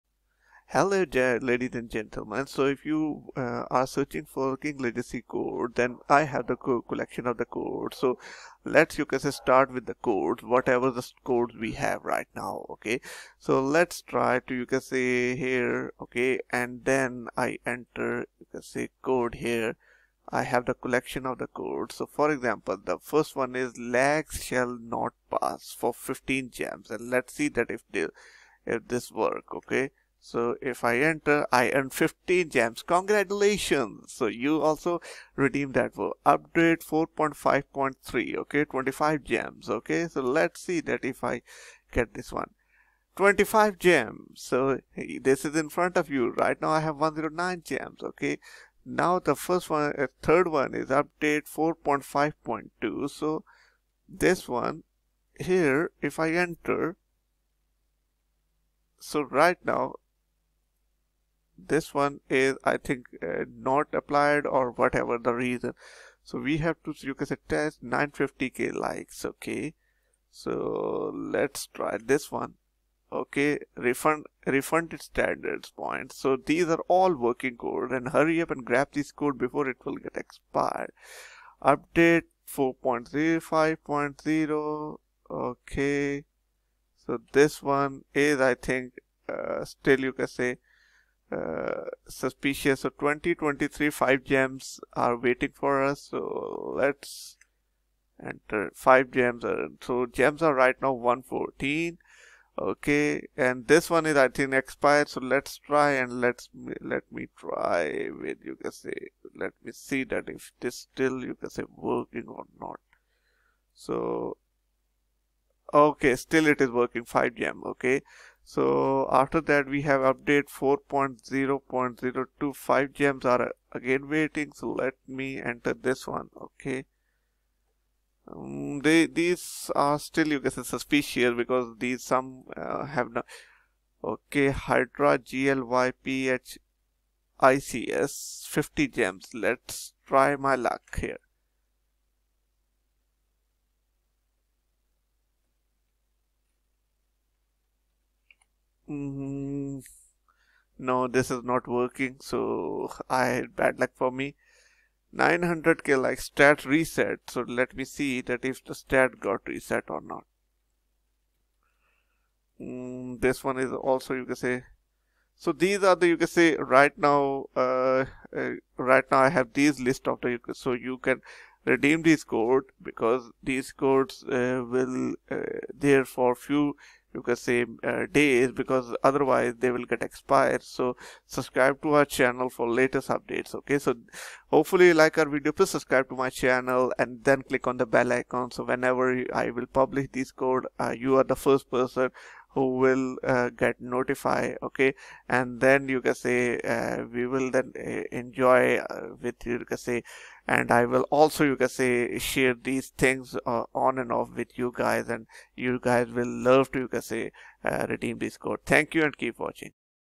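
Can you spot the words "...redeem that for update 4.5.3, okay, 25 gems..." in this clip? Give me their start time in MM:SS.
00:35.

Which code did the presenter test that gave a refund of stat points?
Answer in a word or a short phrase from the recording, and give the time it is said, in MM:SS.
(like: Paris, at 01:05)
950k likes, at 01:07.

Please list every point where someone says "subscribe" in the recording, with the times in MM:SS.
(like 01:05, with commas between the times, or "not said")
03:01, 03:05.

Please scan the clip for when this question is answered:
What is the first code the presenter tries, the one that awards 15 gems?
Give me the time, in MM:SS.
00:23.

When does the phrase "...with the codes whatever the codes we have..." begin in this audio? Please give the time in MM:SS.
00:09.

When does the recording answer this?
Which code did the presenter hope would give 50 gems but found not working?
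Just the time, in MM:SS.
02:14.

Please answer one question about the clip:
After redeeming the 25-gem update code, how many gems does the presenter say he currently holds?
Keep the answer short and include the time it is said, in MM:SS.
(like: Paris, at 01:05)
109, at 00:46.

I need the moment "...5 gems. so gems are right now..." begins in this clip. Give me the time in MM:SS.
01:38.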